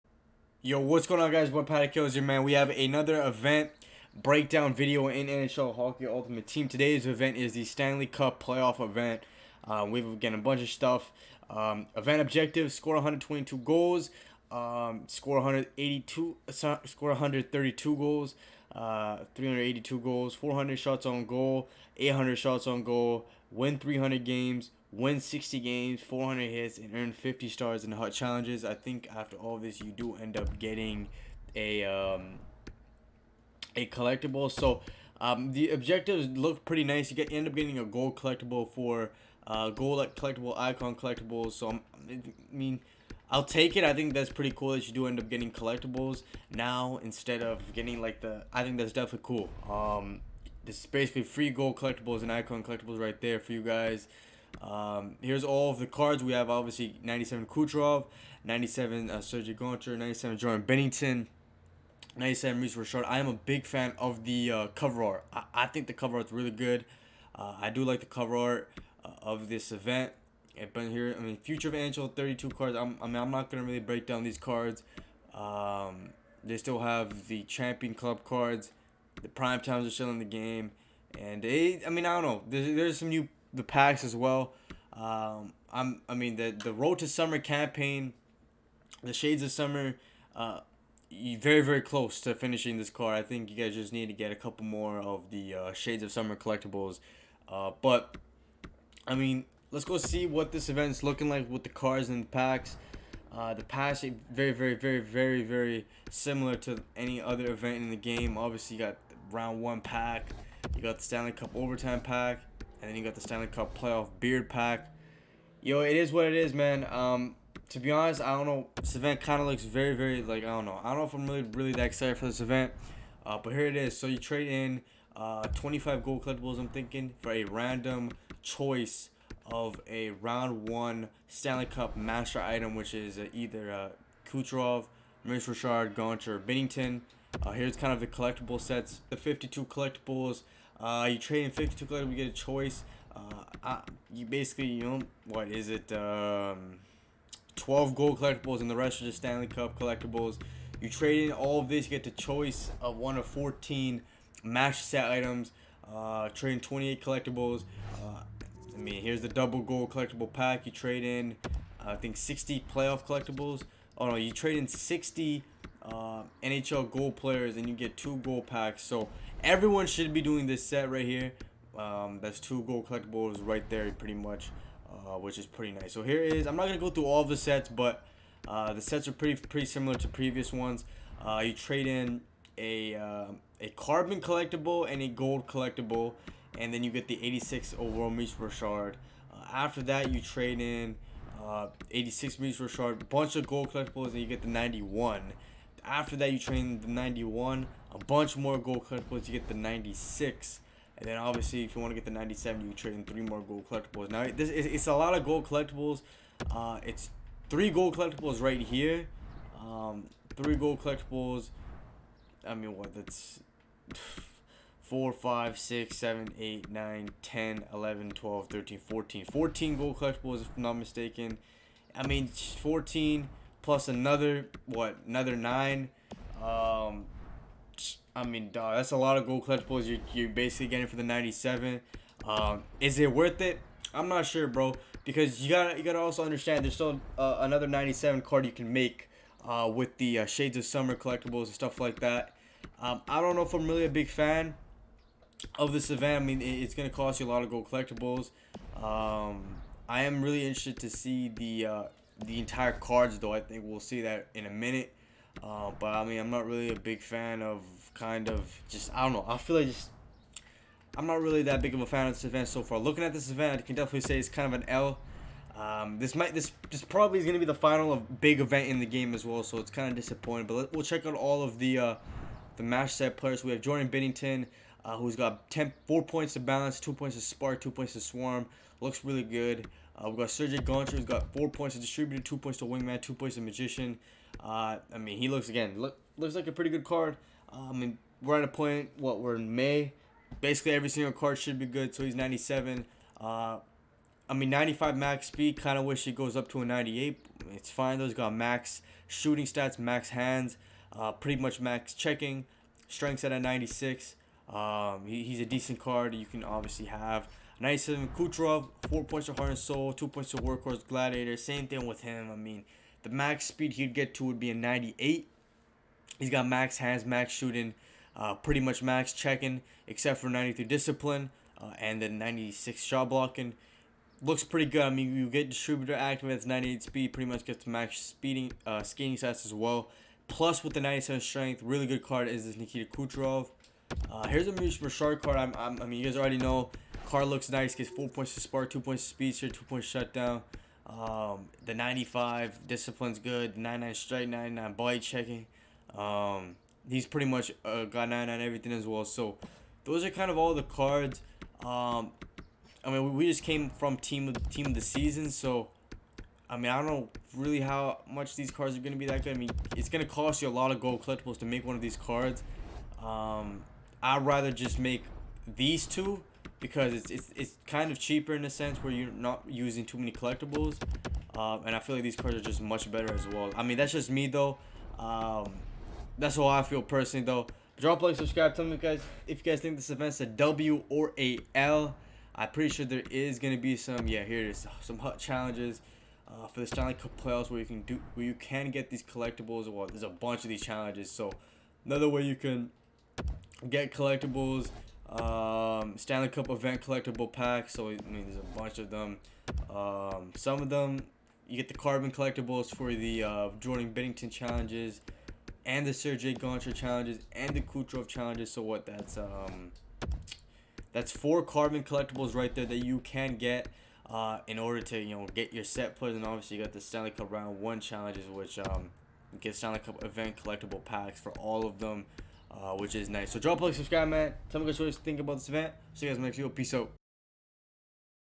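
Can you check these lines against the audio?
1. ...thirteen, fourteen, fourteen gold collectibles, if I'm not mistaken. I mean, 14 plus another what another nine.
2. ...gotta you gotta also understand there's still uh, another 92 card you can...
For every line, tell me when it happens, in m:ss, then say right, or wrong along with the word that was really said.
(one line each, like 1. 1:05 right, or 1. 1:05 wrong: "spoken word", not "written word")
1. 3:38 right
2. 3:55 wrong: "97", not "92".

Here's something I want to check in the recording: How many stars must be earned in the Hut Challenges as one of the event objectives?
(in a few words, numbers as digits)
50.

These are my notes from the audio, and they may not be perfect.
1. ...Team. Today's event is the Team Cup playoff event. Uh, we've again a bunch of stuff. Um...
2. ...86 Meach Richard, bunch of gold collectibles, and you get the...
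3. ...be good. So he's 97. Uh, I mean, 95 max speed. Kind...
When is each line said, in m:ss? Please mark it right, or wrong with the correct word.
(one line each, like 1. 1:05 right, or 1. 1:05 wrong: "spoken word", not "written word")
1. 0:06 wrong: "Stanley", not "Team"
2. 3:11 right
3. 4:51 right.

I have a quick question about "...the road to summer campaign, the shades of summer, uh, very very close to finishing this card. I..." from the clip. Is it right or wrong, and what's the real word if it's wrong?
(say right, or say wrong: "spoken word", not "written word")
right.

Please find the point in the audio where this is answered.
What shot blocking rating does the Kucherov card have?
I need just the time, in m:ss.
5:22.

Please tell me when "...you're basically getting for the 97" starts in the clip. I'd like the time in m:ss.
3:50.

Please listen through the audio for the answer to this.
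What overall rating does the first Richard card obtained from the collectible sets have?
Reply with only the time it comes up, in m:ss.
3:07.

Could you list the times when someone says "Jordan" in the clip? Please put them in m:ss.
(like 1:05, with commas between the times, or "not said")
1:00, 4:33, 6:43.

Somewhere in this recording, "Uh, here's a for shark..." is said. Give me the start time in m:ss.
5:34.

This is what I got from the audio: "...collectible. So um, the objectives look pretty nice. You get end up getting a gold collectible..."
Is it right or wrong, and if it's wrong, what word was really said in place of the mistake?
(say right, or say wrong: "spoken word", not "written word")
right.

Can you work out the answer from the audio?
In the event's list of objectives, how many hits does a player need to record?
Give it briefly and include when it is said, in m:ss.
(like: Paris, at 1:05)
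400, at 0:26.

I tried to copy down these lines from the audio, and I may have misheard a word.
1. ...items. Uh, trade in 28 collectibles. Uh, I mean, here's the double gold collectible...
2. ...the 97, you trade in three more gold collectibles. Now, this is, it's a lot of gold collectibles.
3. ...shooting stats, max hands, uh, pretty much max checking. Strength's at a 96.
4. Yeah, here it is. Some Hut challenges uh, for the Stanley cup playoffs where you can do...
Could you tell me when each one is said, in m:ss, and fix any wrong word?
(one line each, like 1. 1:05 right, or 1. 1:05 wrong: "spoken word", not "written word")
1. 2:35 right
2. 3:22 right
3. 4:59 right
4. 6:24 right.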